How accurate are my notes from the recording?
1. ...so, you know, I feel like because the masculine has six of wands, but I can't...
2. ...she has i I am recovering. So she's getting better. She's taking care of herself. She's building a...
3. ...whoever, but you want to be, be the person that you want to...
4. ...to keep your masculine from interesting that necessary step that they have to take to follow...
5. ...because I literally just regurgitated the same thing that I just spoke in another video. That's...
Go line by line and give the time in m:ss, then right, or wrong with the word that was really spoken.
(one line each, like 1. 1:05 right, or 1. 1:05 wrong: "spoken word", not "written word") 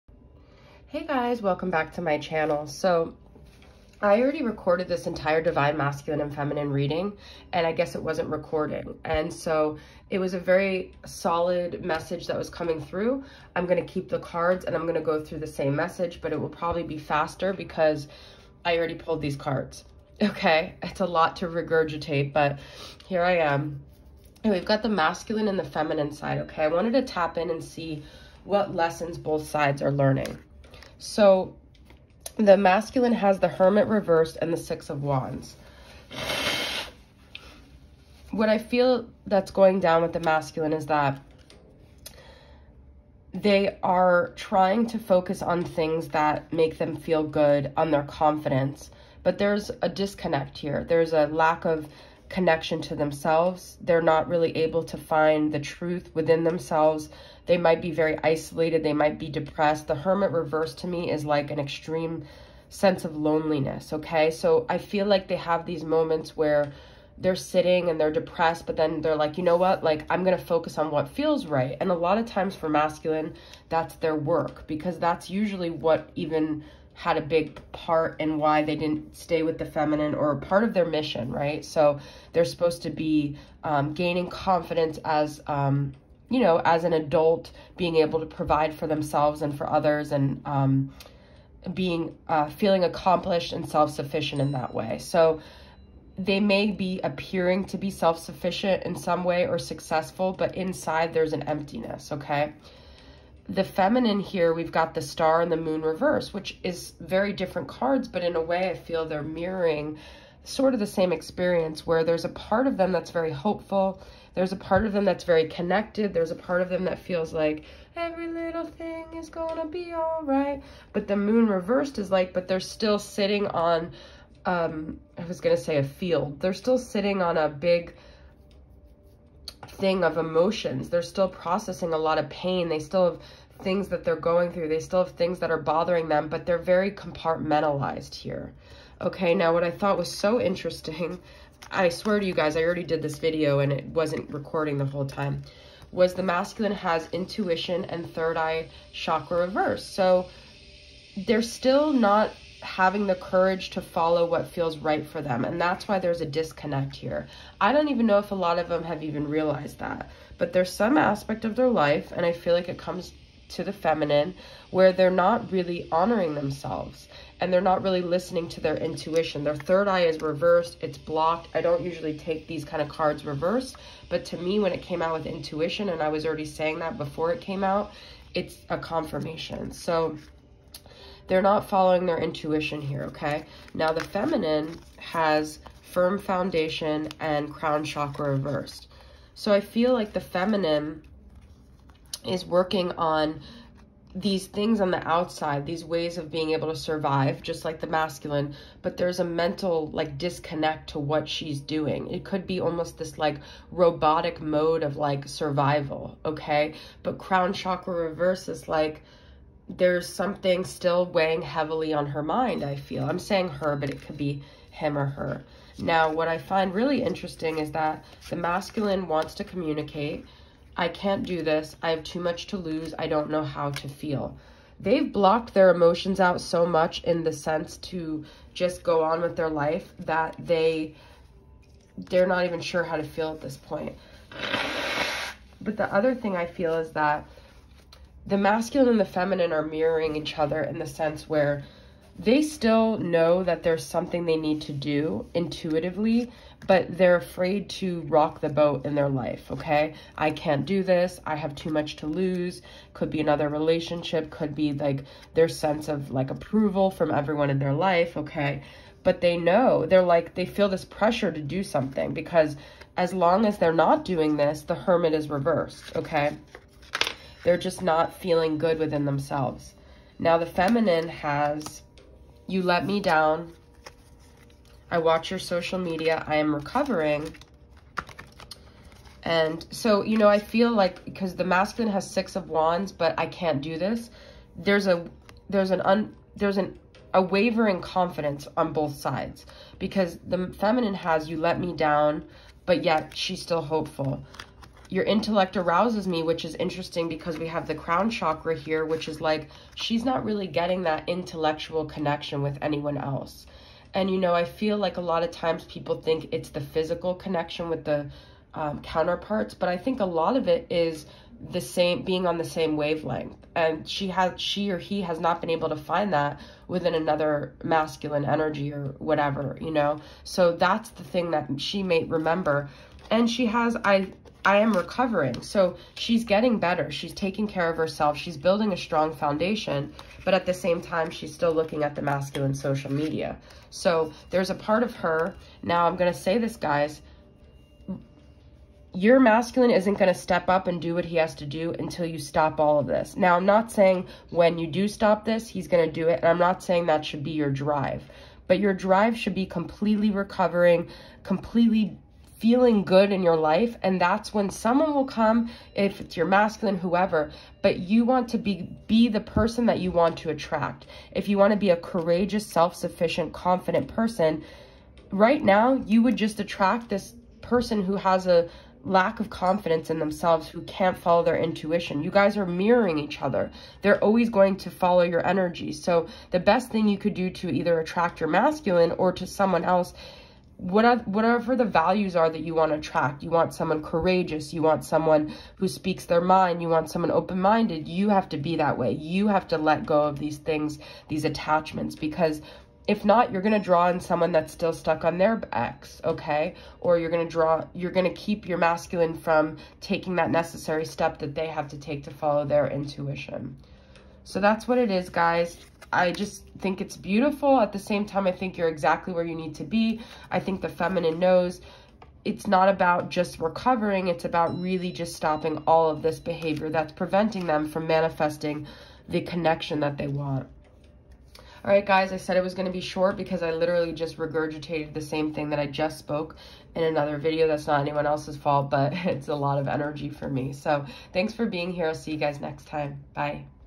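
1. 4:39 right
2. 5:23 right
3. 5:56 right
4. 6:38 wrong: "taking", not "interesting"
5. 7:03 right.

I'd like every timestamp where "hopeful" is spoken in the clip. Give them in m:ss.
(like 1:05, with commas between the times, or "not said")
1:53, 4:53.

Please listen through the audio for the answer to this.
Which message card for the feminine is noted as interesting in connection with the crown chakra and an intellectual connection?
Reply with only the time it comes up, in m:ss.
4:54.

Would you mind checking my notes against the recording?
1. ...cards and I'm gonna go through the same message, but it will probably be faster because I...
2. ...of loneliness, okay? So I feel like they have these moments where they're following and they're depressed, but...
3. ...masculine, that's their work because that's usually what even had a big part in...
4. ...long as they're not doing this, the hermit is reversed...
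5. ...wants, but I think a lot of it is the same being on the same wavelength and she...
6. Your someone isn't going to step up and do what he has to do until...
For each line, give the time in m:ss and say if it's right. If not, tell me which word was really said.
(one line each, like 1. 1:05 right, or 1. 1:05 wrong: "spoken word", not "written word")
1. 0:14 right
2. 1:03 wrong: "sitting", not "following"
3. 1:12 right
4. 4:23 right
5. 5:08 wrong: "counterparts", not "wants"
6. 5:38 wrong: "masculine", not "someone".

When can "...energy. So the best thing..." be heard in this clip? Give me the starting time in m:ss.
6:15.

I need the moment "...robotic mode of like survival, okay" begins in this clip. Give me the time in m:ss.
3:23.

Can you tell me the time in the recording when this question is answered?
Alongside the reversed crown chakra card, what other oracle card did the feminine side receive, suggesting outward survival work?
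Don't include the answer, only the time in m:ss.
3:05.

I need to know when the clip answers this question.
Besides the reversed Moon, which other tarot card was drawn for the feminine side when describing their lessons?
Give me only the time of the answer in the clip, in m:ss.
1:44.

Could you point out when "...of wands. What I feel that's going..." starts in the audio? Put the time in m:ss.
0:34.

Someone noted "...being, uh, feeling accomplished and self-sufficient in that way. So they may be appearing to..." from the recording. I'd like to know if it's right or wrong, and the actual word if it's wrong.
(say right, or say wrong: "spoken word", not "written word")
right.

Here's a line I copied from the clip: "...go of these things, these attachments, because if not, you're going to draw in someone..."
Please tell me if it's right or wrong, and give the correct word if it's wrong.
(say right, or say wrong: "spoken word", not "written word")
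right.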